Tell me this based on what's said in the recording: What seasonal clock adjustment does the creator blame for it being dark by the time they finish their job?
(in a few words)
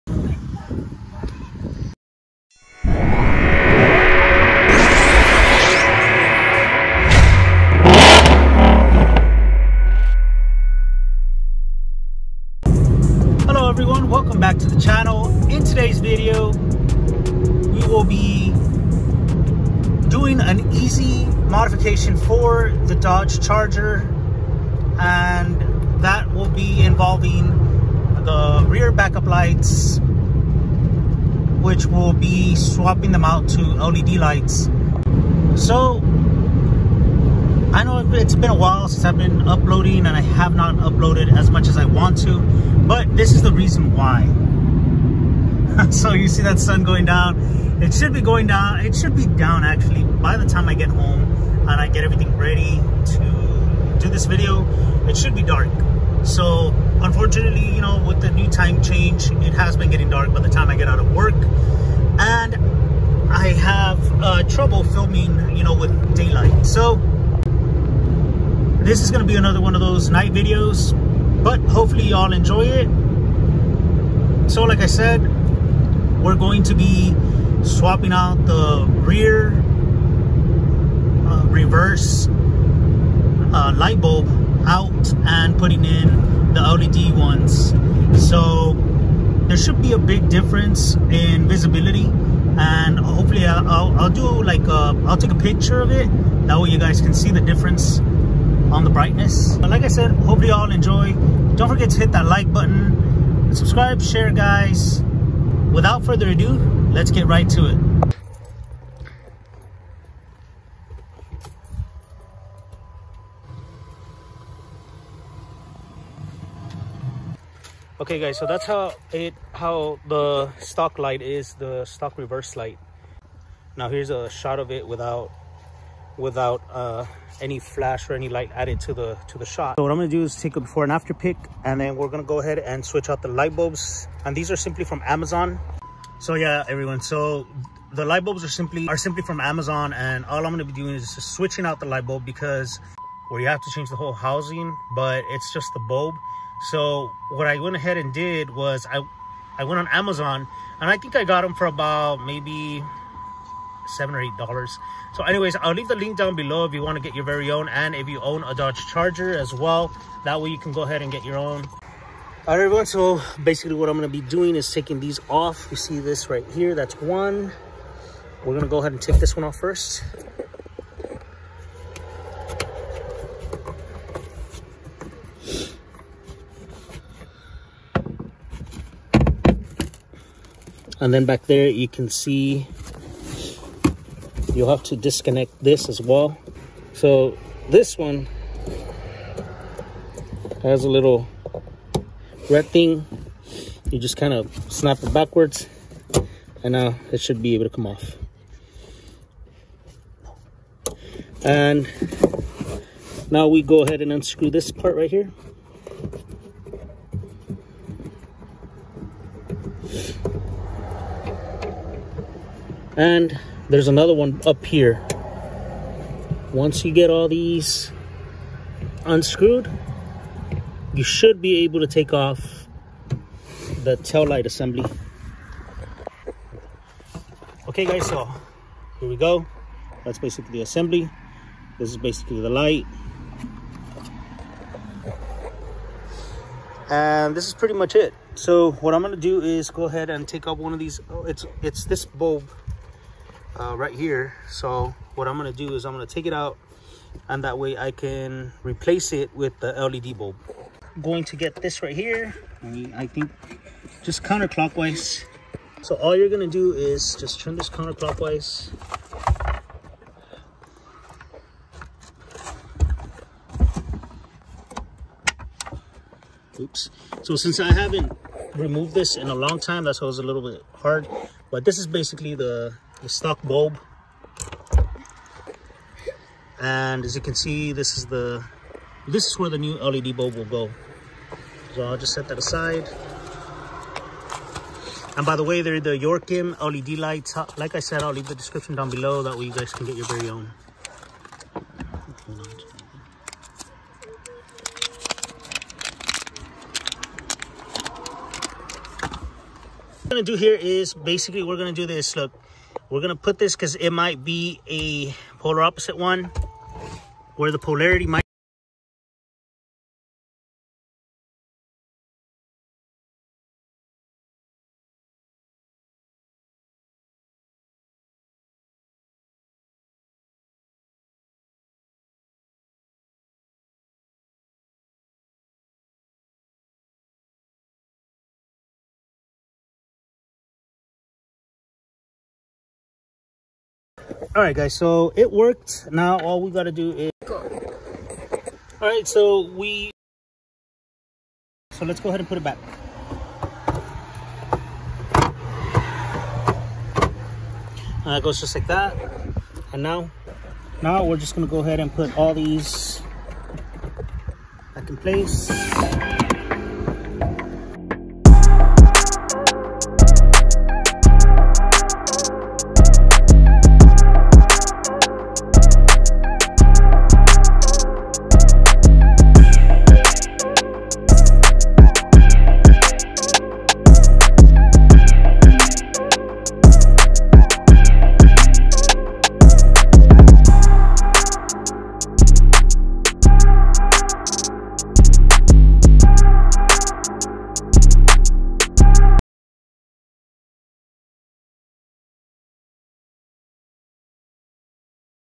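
time change.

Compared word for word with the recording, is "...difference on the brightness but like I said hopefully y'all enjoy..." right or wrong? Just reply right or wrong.
right.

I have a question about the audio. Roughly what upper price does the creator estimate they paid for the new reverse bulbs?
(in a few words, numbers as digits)
$8.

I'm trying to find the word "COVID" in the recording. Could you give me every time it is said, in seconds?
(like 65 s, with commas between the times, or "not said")
not said.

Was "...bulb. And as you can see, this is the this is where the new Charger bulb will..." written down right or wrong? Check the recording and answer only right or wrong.
wrong.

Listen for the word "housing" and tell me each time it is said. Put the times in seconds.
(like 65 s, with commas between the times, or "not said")
144 s.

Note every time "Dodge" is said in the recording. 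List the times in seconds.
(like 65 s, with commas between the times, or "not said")
22 s, 158 s.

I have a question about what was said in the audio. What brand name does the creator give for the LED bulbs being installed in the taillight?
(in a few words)
Yorkim.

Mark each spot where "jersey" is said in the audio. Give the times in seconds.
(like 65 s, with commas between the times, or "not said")
not said.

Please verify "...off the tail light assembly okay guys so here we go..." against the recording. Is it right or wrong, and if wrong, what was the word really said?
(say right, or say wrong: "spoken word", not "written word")
right.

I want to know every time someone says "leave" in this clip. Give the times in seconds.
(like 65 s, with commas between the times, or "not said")
155 s, 288 s.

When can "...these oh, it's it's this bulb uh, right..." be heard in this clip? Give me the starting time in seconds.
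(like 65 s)
240 s.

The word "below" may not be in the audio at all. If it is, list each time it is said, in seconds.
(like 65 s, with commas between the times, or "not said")
156 s, 288 s.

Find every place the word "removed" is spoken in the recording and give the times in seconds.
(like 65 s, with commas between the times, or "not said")
268 s.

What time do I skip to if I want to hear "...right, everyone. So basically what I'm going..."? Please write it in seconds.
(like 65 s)
162 s.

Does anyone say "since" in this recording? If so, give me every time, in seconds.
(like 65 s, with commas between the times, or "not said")
38 s, 267 s.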